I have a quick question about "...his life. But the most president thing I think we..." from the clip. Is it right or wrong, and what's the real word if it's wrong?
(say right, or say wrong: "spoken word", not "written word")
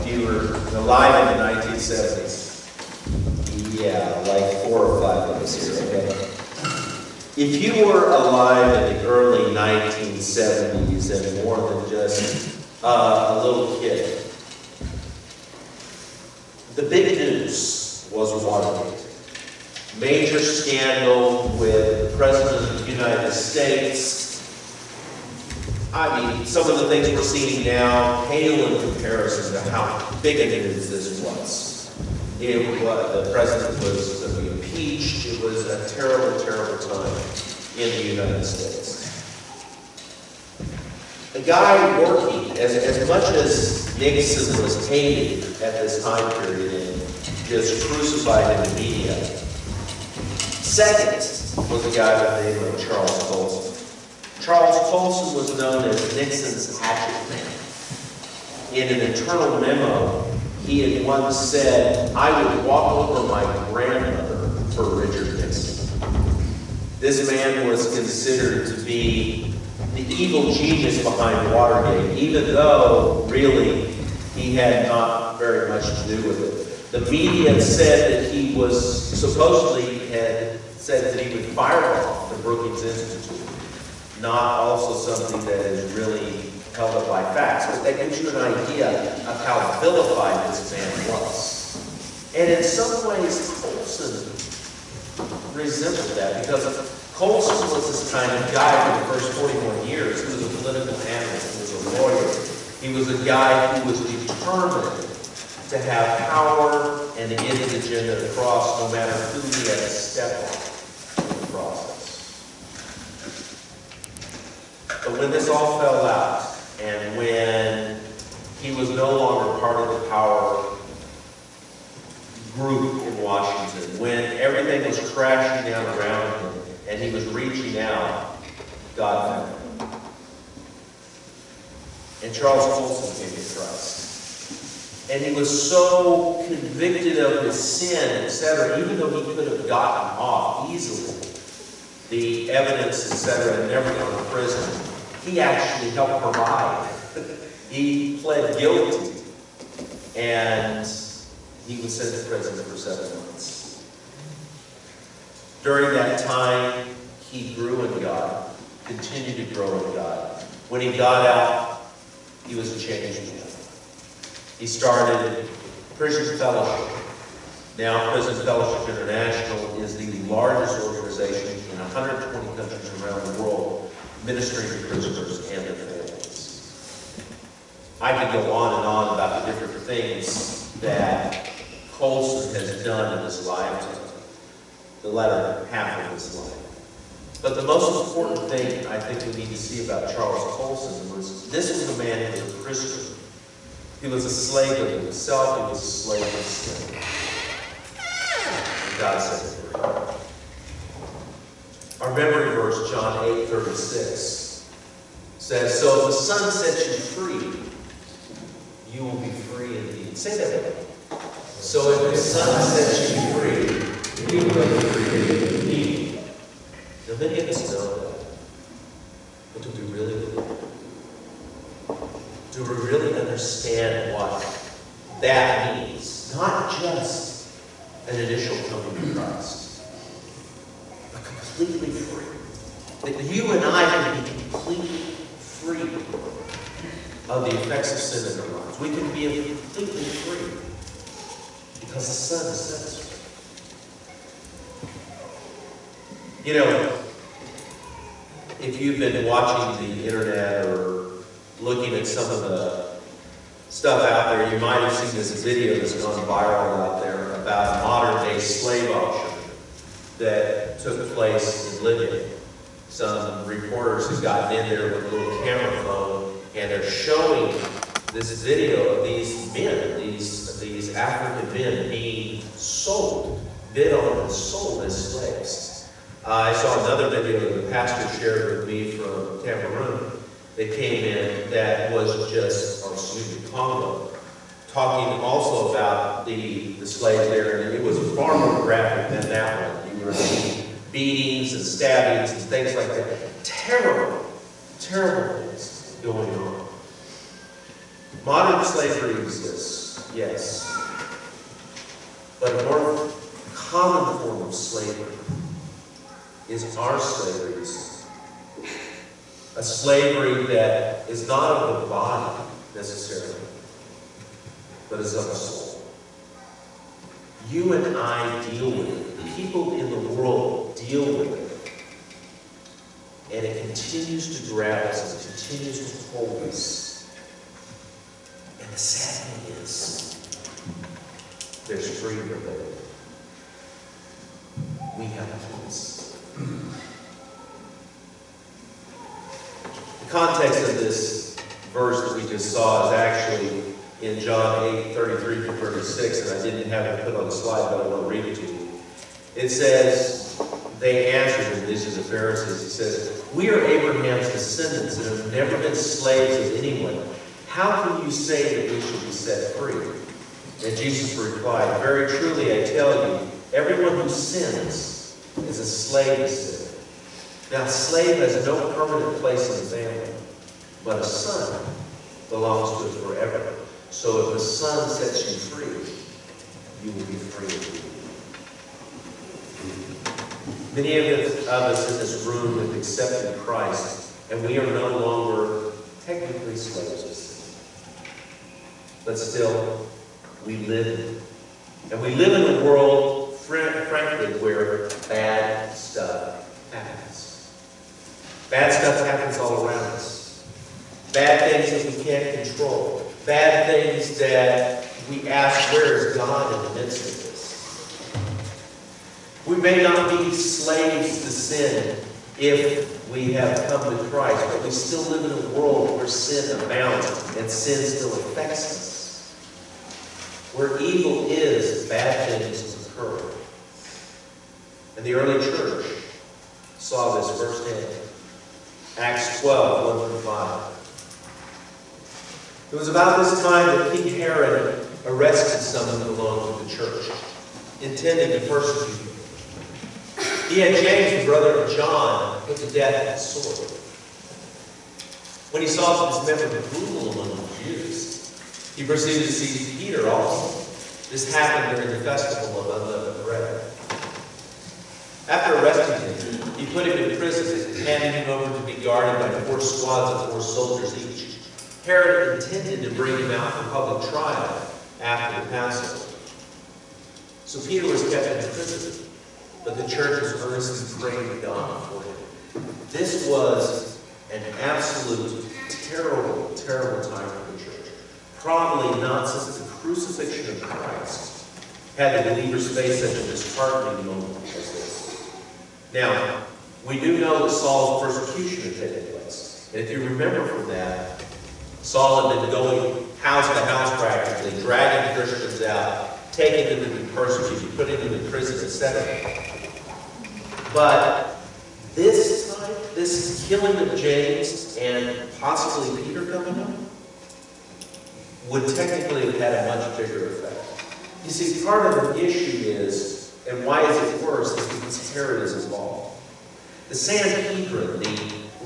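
wrong: "important", not "president".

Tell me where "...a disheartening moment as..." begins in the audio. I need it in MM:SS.
08:03.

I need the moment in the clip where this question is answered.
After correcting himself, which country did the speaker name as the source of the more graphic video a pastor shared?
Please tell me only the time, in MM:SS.
04:43.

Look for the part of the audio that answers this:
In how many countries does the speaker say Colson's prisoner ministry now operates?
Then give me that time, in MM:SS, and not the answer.
02:51.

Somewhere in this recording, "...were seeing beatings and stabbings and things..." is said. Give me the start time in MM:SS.
04:50.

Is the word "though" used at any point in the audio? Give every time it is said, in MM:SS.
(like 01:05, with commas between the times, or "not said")
01:12, 02:18.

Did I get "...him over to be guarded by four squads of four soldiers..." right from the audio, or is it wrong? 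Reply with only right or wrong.
right.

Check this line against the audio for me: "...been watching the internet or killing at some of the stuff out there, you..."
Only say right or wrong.
wrong.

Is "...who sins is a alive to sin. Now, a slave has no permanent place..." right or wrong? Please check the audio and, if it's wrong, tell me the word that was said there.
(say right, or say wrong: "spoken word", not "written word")
wrong: "slave", not "alive".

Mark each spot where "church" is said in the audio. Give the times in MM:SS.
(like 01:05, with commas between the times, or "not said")
07:05, 07:16, 07:49, 07:57.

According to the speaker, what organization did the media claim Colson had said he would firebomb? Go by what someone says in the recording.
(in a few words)
Brookings Institute.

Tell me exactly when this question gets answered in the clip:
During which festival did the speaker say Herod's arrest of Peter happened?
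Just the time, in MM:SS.
07:31.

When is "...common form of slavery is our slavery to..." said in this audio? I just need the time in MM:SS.
05:03.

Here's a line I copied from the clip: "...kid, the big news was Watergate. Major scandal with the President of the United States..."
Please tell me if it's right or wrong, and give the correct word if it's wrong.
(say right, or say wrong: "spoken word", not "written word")
right.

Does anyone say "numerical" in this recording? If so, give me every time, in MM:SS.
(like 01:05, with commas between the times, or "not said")
not said.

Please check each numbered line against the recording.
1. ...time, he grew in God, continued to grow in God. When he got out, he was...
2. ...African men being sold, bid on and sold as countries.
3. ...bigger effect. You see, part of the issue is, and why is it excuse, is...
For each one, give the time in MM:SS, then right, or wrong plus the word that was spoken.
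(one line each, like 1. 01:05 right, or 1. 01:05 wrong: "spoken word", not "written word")
1. 02:36 right
2. 04:30 wrong: "slaves", not "countries"
3. 08:29 wrong: "worse", not "excuse".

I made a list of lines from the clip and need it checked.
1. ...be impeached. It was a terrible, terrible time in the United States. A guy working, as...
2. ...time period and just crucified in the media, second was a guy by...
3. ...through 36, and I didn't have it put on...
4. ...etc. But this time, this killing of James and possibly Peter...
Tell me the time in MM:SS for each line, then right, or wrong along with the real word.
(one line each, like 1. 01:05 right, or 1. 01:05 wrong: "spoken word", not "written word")
1. 00:34 right
2. 00:46 right
3. 05:45 right
4. 08:18 right.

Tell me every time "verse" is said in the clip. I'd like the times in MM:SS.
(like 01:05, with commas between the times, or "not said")
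03:22, 05:41.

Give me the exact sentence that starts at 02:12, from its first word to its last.
And Charles Colson came to Christ.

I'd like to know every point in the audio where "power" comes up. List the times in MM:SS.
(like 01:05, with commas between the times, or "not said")
01:46, 02:00.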